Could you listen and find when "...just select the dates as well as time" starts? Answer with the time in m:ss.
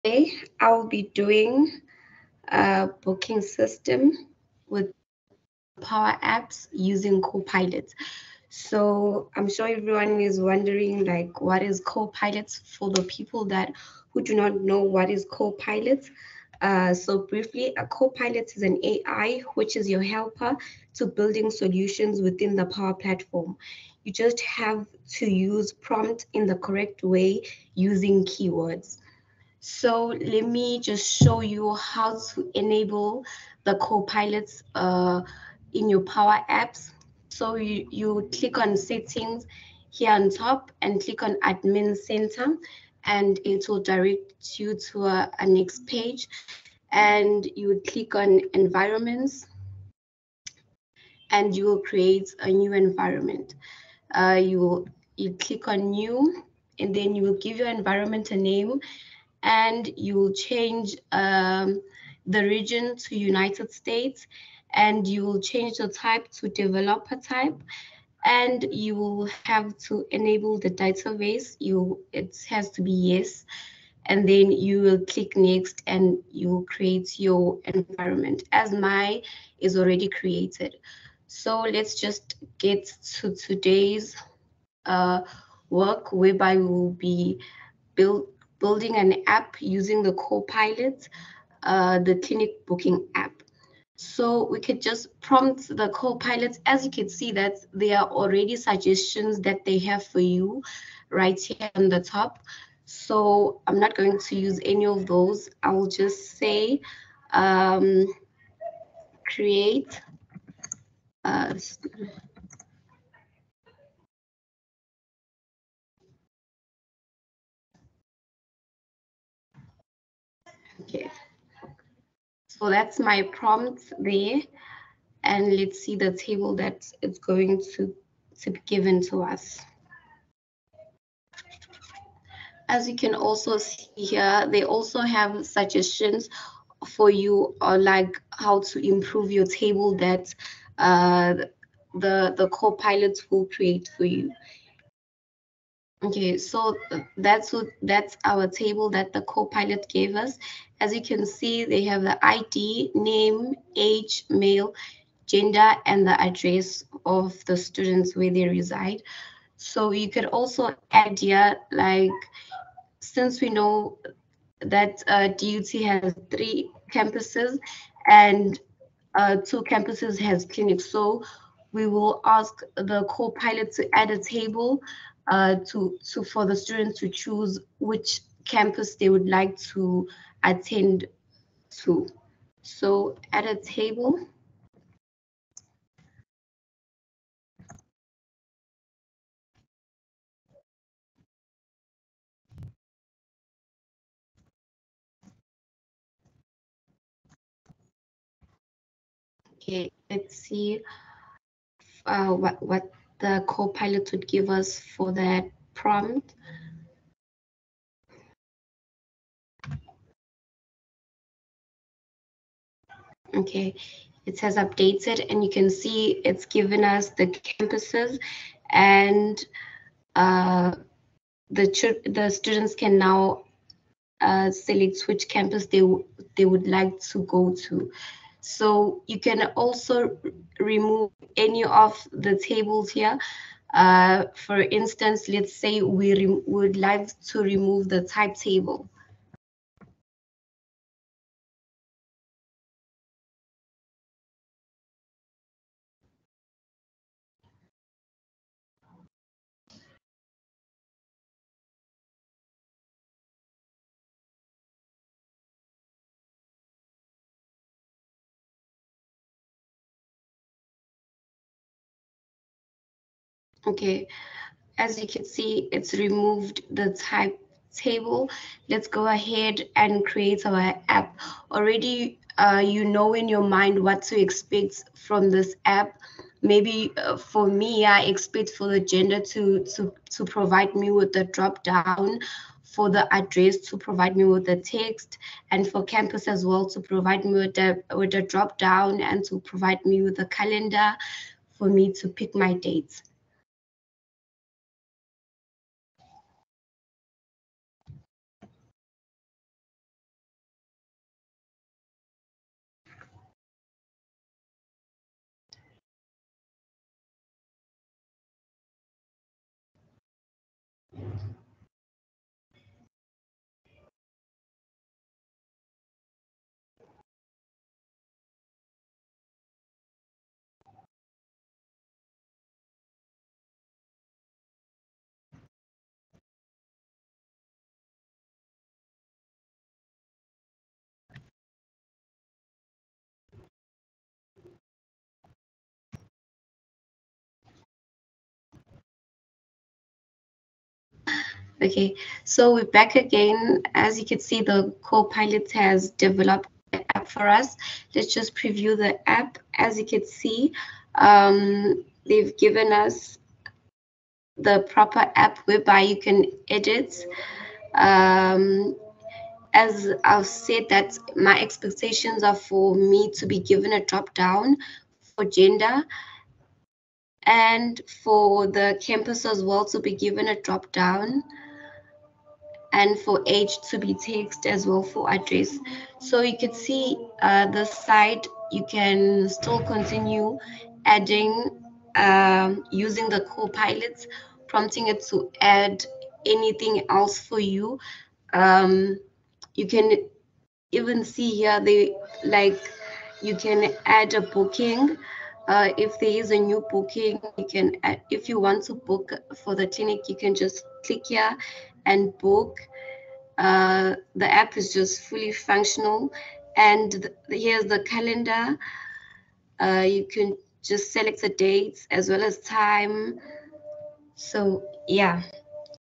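6:50.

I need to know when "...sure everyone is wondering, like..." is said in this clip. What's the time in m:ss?
0:09.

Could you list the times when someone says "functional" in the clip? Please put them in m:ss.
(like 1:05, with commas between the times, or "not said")
6:45.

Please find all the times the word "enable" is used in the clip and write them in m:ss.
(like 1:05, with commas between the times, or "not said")
0:32, 1:10.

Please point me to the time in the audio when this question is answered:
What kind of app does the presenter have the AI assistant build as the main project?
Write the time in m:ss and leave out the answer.
1:31.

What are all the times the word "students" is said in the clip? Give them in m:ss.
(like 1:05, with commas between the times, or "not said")
2:37, 2:56, 3:42.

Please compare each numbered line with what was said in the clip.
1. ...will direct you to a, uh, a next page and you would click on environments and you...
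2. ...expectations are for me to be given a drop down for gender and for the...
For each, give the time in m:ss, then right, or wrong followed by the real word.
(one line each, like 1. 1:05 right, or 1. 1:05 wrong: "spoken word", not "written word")
1. 0:43 right
2. 6:01 right.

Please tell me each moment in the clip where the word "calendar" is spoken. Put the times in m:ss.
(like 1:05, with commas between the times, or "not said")
4:50, 6:47.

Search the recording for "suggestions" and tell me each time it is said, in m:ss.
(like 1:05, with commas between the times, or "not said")
1:38, 2:15.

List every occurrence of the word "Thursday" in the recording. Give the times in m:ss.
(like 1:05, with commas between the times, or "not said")
not said.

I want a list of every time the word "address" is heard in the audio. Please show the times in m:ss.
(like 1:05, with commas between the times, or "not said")
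2:36, 4:43, 6:15.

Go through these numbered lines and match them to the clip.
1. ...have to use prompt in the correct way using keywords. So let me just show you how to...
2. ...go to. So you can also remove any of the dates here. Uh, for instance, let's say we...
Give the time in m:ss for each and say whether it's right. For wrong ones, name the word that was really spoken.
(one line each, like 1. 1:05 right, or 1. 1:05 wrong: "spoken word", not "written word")
1. 0:24 right
2. 3:47 wrong: "tables", not "dates".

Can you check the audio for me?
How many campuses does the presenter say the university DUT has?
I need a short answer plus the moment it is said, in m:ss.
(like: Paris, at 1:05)
3, at 2:46.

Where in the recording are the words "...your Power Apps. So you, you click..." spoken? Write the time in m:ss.
0:35.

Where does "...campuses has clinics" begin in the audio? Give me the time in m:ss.
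2:49.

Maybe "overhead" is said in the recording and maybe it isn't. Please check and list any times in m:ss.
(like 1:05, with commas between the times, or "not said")
not said.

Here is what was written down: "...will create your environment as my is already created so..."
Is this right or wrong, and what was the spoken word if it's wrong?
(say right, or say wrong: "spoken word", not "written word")
right.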